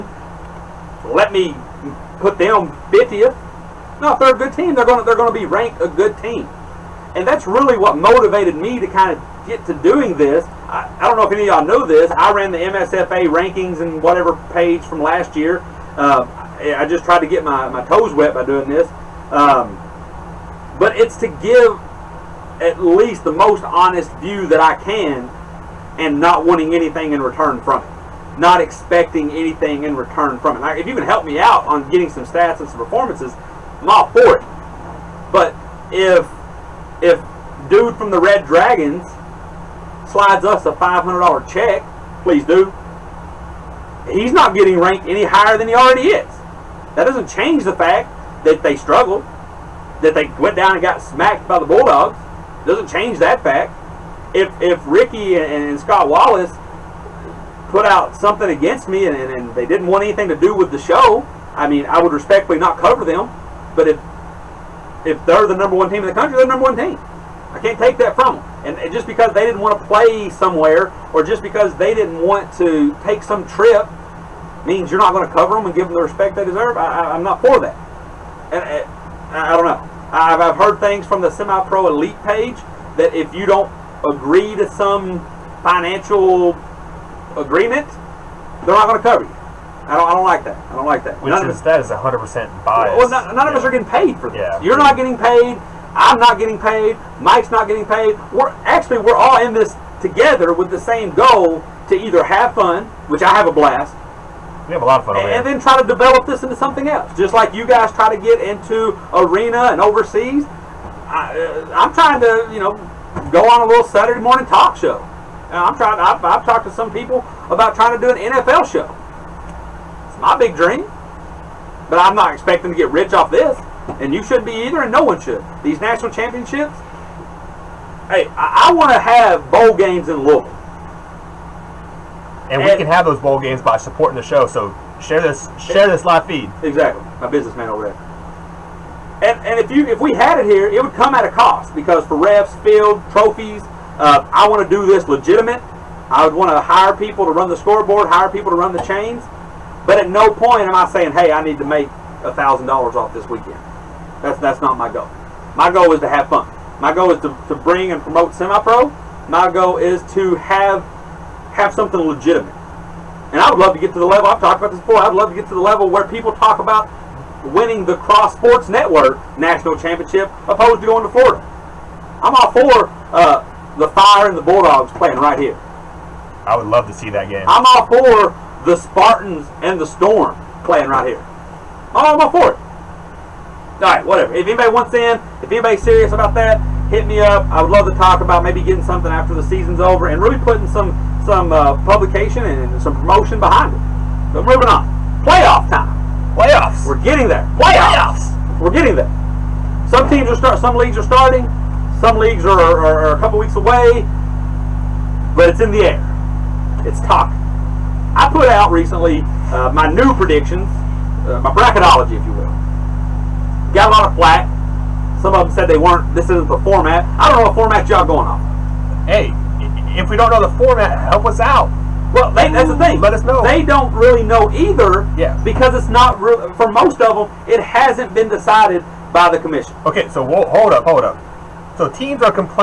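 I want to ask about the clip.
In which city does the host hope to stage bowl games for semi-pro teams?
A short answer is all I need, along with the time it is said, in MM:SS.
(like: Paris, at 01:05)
Louisville, at 02:10.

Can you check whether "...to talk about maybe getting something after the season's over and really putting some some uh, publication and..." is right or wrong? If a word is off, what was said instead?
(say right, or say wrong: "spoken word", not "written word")
right.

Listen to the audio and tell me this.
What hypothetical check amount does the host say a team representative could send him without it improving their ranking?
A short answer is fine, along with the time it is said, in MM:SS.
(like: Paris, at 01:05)
$500, at 00:40.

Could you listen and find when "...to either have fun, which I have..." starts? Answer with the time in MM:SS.
01:41.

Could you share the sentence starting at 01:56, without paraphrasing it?
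I've, I've talked to some people about trying to do an NFL show my big dream.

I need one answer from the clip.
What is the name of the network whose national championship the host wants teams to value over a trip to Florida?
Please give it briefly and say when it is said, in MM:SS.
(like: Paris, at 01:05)
Cross Sports Network, at 02:47.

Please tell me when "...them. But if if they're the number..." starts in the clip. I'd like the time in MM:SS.
01:03.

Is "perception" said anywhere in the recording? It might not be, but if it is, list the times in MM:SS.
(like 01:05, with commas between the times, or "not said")
not said.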